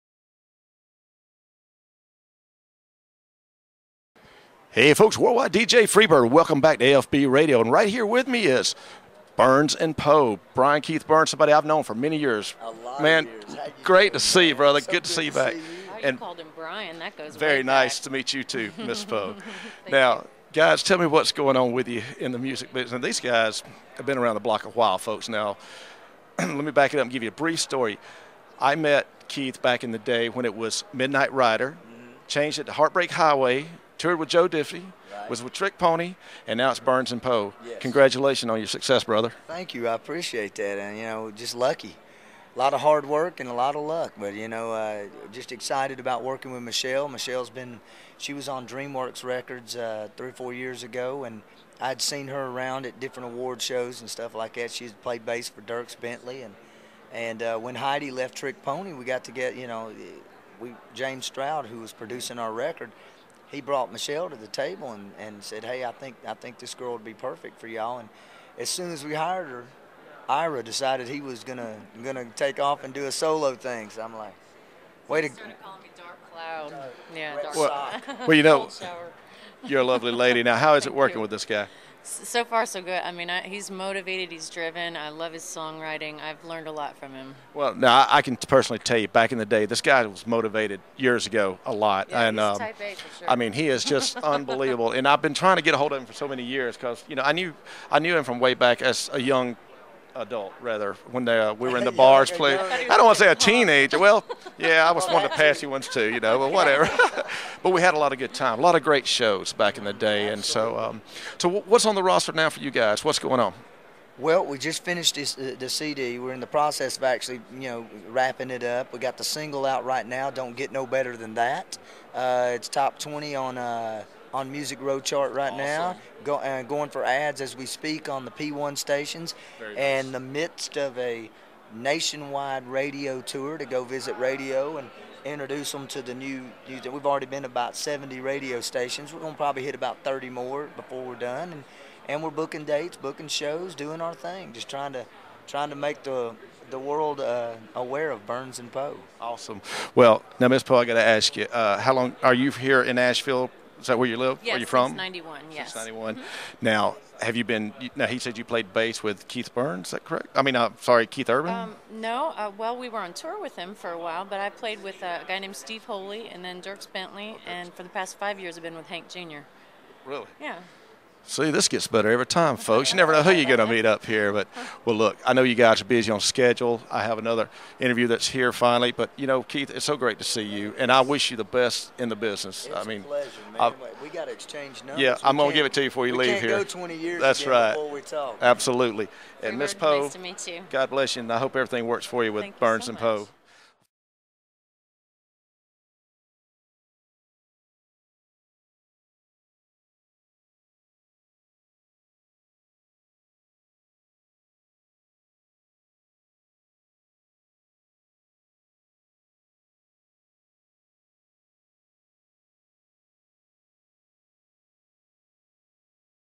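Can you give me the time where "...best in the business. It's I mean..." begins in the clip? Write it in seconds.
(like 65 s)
181 s.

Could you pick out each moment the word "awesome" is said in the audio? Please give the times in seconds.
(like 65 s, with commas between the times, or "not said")
125 s, 149 s.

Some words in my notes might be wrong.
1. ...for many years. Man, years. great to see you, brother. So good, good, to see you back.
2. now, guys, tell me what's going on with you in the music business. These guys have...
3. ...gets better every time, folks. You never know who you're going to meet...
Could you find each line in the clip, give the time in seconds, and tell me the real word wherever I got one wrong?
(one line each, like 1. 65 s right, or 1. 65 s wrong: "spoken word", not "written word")
1. 11 s right
2. 19 s right
3. 171 s right.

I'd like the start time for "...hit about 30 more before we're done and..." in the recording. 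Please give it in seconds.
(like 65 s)
139 s.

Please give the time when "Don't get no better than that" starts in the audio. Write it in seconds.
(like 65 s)
120 s.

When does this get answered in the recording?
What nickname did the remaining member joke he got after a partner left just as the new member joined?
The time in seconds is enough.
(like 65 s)
75 s.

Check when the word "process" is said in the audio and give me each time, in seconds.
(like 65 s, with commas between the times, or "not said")
116 s.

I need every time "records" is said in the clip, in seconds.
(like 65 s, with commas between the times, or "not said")
49 s, 62 s.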